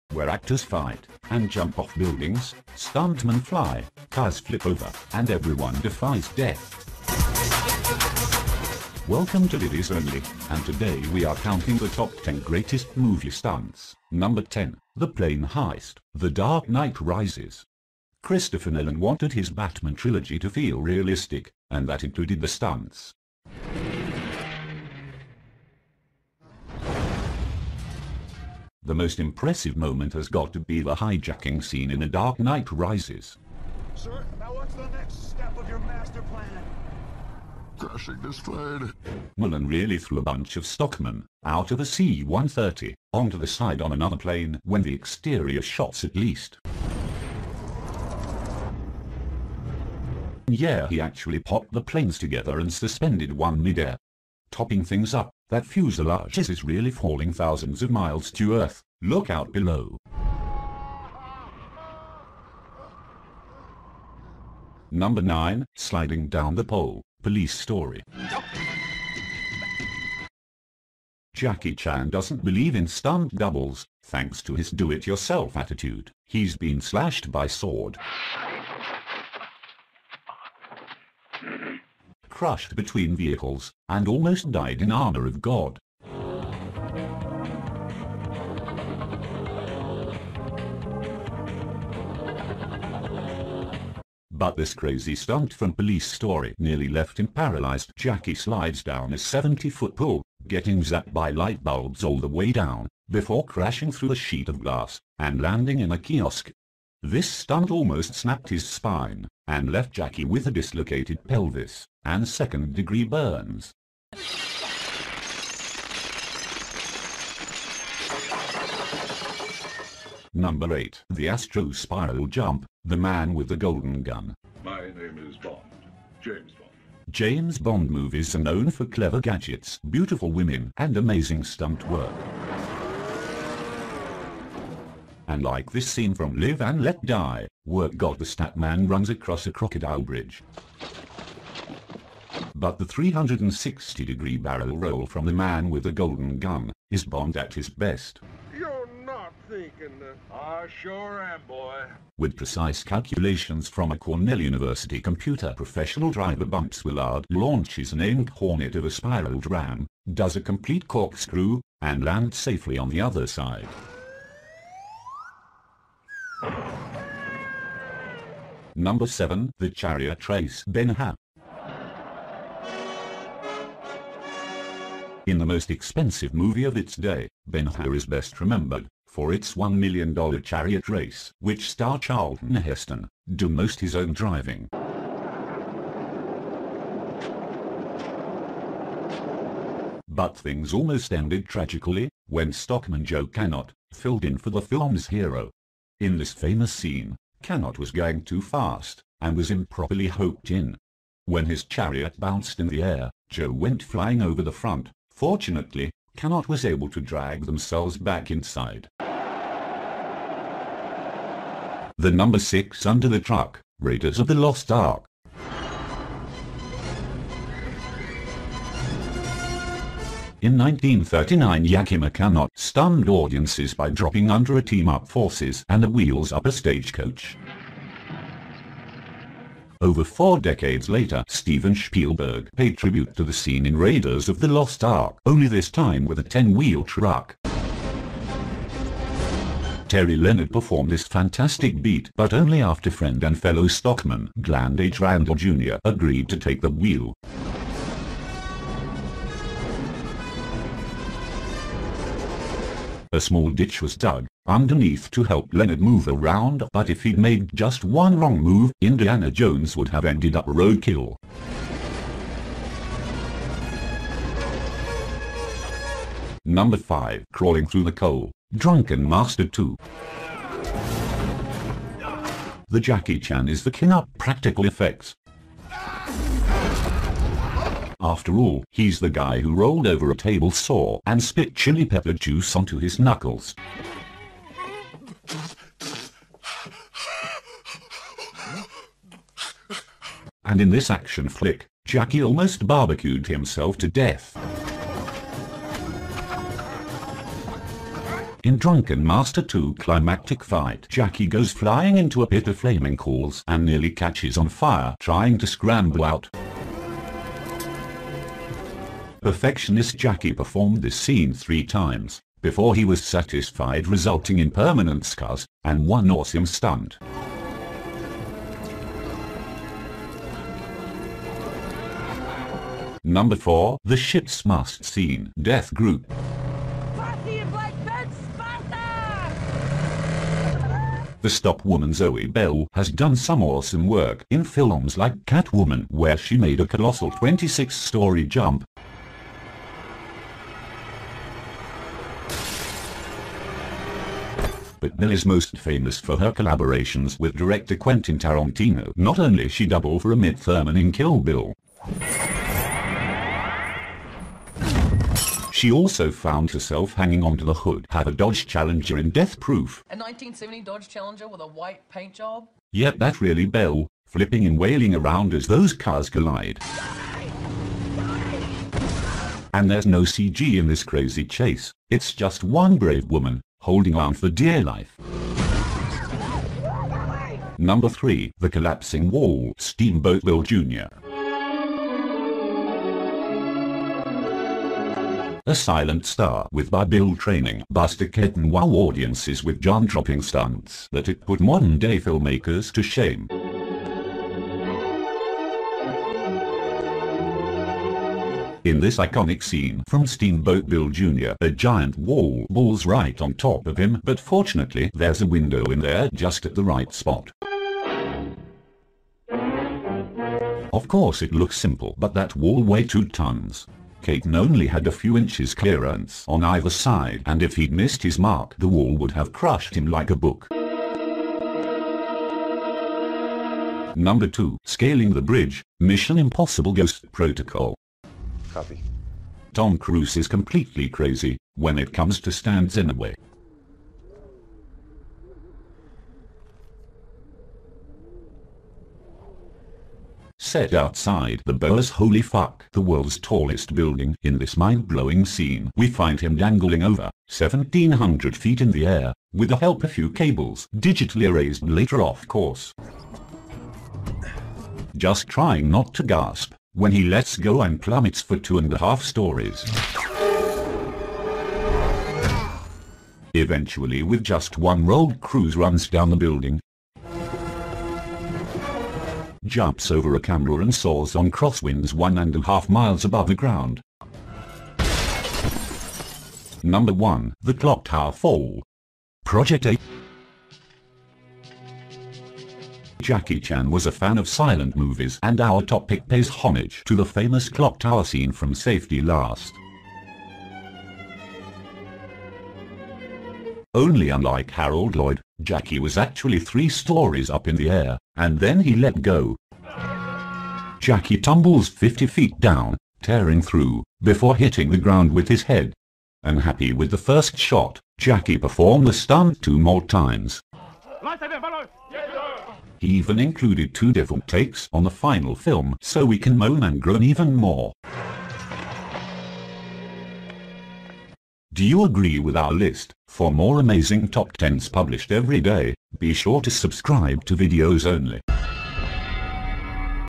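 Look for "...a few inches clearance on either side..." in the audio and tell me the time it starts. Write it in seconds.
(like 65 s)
414 s.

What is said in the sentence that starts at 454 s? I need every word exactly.
Just trying not to gasp when he lets go and plummets for two and a half stories.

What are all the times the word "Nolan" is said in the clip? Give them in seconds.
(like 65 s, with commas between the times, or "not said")
18 s, 39 s.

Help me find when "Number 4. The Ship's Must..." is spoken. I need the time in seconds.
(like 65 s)
323 s.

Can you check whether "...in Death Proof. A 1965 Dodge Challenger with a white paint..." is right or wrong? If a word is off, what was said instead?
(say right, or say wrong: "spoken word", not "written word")
wrong: "1970", not "1965".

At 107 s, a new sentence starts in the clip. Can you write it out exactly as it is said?
This stunt almost snapped his spine, and left Jackie with a dislocated pelvis and second-degree burns.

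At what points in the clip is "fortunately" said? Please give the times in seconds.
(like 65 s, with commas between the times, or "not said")
205 s, 404 s.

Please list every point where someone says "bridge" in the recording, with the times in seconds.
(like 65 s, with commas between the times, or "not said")
140 s, 425 s.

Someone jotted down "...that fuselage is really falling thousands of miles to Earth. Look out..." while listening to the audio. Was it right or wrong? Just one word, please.
right.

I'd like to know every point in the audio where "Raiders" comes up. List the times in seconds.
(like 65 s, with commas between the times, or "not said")
213 s, 233 s.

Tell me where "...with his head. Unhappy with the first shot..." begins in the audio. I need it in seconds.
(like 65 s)
505 s.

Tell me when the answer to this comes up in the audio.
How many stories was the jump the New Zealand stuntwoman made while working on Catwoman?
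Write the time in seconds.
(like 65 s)
337 s.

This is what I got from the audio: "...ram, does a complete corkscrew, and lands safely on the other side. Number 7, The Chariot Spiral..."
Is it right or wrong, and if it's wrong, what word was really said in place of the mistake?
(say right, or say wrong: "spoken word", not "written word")
wrong: "Race", not "Spiral".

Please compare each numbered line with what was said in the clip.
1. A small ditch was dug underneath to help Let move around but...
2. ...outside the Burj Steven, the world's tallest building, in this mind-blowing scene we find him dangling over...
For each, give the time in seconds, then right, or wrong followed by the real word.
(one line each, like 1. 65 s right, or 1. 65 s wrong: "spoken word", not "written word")
1. 253 s wrong: "Leonard", not "Let"
2. 440 s wrong: "Khalifa", not "Steven".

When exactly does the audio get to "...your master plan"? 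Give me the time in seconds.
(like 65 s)
35 s.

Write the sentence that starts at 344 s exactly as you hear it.
but Bill is most famous for her collaborations with director Quentin Tarantino.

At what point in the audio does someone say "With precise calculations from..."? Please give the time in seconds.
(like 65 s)
152 s.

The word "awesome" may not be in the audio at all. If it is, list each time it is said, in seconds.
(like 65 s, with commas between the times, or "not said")
316 s, 333 s.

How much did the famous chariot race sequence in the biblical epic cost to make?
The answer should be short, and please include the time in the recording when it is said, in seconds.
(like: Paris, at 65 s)
$1 million, at 179 s.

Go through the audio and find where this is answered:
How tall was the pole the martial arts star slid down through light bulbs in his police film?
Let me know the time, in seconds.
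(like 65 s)
99 s.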